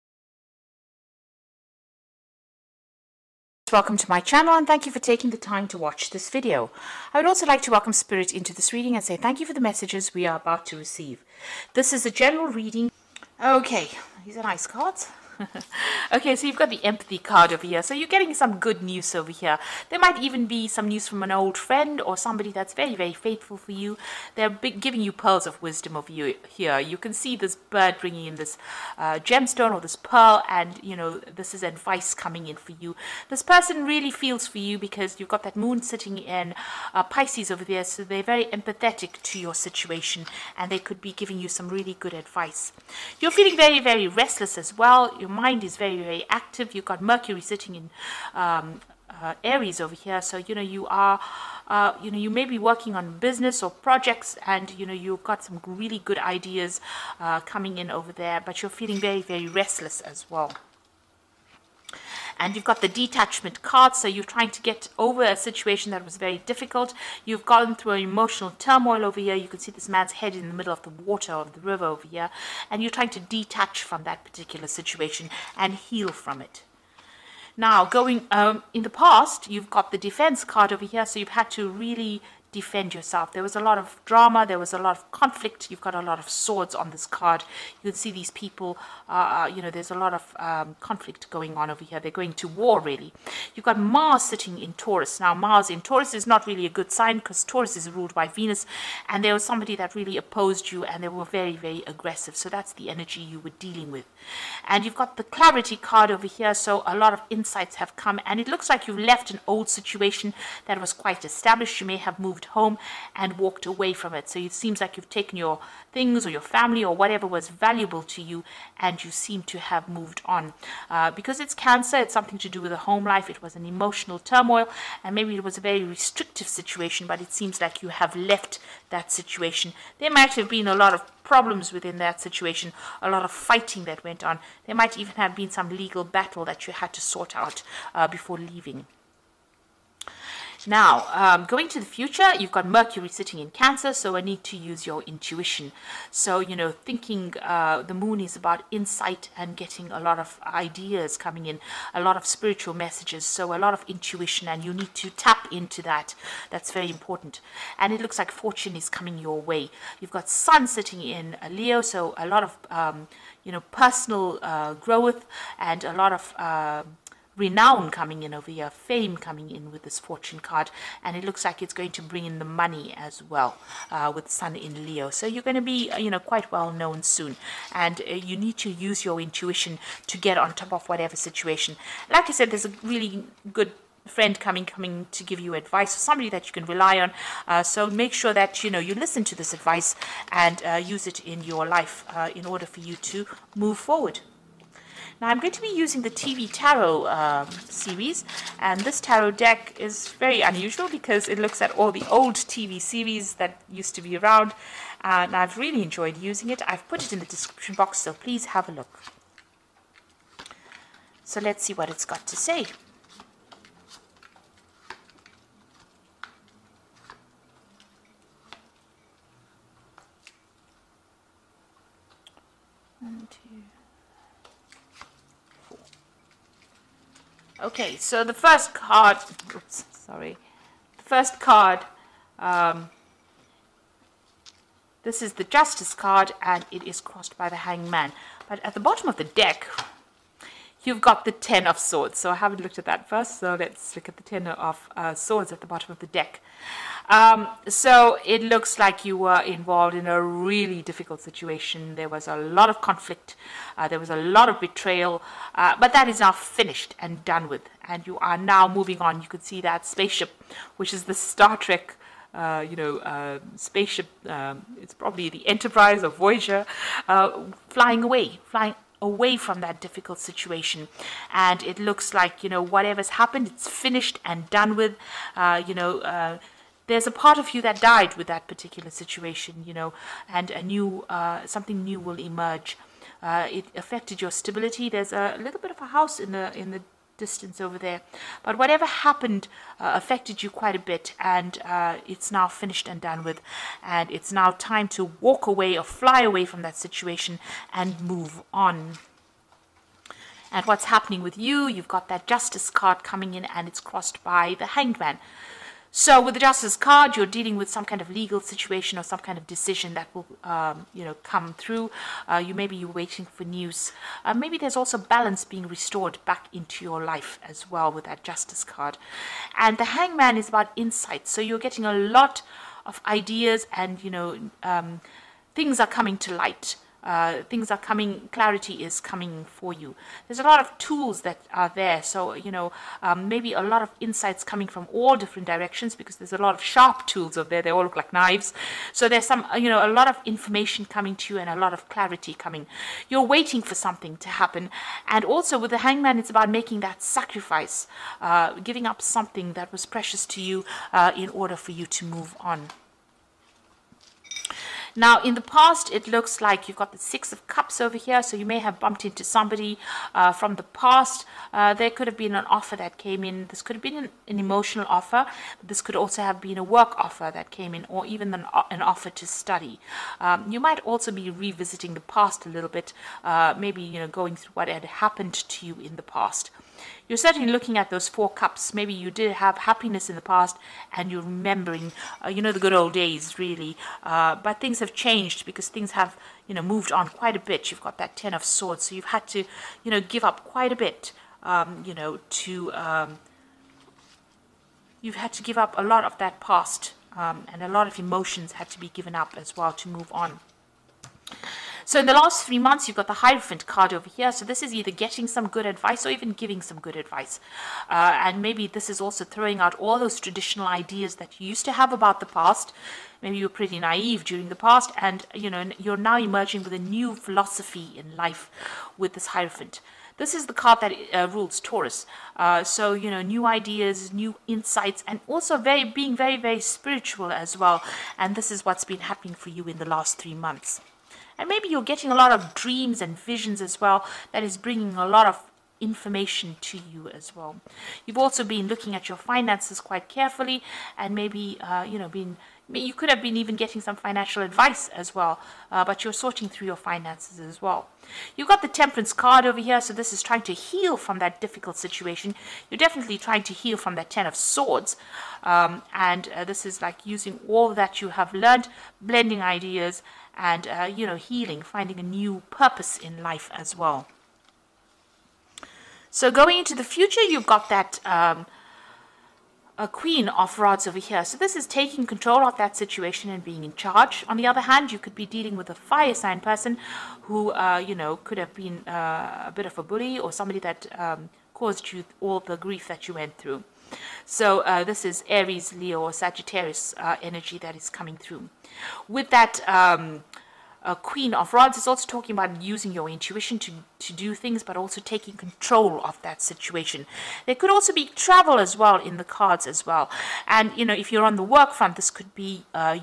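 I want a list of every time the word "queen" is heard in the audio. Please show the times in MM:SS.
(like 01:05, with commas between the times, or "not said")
07:49, 08:10.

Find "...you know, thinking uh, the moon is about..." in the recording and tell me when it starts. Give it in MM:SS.
02:26.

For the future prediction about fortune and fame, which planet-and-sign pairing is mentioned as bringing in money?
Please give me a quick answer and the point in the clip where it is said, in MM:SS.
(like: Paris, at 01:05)
Sun in Leo, at 02:54.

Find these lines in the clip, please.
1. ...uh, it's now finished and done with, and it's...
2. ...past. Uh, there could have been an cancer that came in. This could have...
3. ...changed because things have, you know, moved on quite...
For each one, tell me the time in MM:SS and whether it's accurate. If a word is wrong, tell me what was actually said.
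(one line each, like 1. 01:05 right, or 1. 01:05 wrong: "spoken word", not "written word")
1. 04:51 right
2. 06:00 wrong: "offer", not "cancer"
3. 06:24 right.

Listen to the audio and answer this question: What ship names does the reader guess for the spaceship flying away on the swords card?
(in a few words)
Enterprise or Voyager.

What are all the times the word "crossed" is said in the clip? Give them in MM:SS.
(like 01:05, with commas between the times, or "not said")
03:56, 05:03.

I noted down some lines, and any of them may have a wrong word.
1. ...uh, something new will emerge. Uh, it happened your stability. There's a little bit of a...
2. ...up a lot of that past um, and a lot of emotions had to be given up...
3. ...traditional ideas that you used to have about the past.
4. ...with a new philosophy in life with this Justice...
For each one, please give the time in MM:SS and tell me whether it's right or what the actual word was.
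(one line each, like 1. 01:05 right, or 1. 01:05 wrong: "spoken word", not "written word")
1. 04:41 wrong: "affected", not "happened"
2. 06:35 right
3. 06:50 right
4. 06:56 wrong: "Hierophant", not "Justice".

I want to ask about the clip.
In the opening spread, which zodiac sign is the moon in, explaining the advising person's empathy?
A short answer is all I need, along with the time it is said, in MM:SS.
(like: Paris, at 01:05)
Pisces, at 00:37.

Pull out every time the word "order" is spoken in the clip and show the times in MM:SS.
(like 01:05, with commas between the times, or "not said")
03:12, 05:51.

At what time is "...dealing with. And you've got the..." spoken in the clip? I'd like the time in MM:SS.
01:43.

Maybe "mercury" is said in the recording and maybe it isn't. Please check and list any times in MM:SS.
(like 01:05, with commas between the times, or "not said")
00:47, 02:22.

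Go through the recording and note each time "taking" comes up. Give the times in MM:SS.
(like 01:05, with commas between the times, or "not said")
00:04, 07:51, 08:14.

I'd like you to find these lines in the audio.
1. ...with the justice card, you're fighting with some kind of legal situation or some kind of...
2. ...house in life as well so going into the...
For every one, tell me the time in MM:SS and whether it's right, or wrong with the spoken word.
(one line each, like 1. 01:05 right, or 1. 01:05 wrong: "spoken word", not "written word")
1. 05:06 wrong: "dealing", not "fighting"
2. 07:42 wrong: "purpose", not "house".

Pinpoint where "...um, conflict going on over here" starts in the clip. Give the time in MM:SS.
01:30.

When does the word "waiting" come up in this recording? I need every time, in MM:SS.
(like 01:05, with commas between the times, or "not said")
05:12, 05:43.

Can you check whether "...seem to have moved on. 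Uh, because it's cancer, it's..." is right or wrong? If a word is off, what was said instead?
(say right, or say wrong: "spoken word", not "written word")
right.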